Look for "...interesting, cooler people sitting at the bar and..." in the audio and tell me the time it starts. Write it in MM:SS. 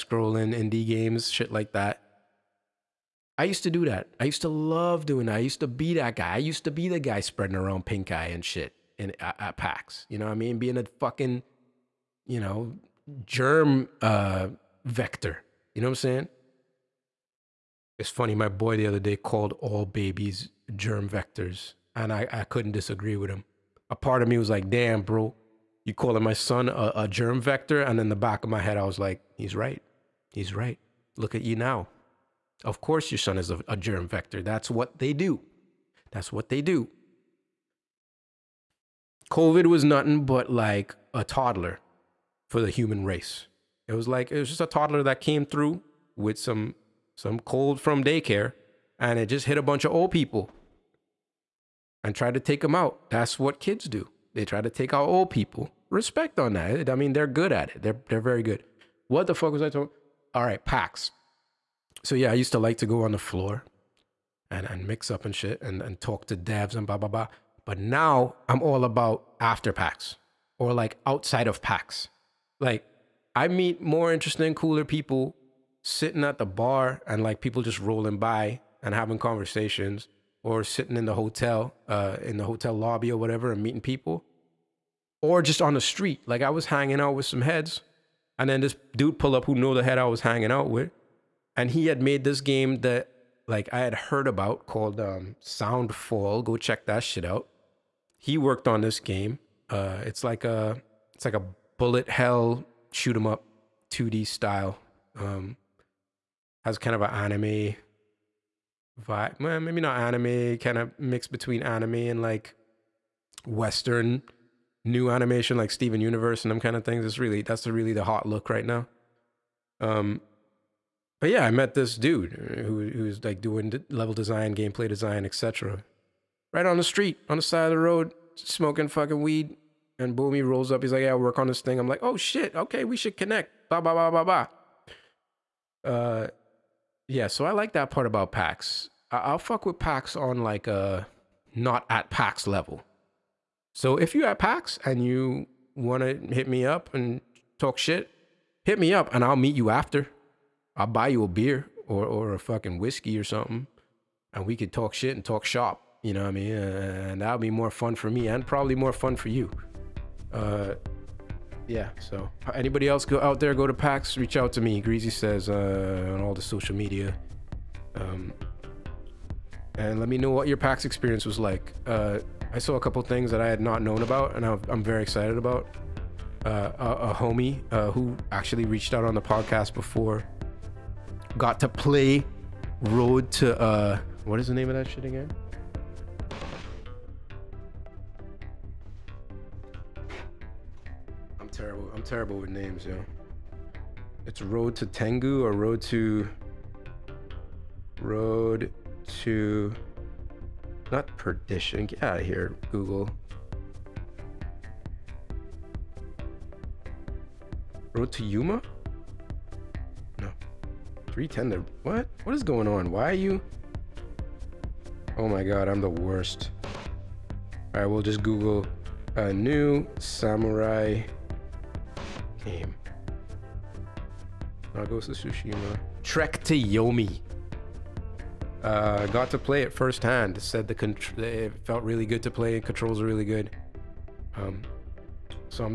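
01:14.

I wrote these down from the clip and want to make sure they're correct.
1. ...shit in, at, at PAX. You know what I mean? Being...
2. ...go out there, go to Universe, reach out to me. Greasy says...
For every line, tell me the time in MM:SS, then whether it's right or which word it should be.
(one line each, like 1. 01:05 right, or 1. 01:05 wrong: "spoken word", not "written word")
1. 00:08 right
2. 02:43 wrong: "PAX", not "Universe".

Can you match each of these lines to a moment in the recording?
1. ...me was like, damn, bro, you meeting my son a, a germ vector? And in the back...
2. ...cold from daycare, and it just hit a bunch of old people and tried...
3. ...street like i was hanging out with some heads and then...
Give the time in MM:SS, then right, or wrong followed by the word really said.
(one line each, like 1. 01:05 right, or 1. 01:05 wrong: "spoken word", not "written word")
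1. 00:24 wrong: "calling", not "meeting"
2. 00:47 right
3. 01:25 right.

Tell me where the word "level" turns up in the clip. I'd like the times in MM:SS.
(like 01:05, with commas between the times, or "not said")
02:03, 02:22.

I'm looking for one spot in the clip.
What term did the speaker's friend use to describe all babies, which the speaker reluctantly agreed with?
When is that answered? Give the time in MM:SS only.
00:20.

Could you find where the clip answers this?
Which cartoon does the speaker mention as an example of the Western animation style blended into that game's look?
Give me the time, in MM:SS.
01:55.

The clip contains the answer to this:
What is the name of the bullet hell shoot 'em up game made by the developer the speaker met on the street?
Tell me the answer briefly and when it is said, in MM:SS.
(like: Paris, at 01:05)
Soundfall, at 01:35.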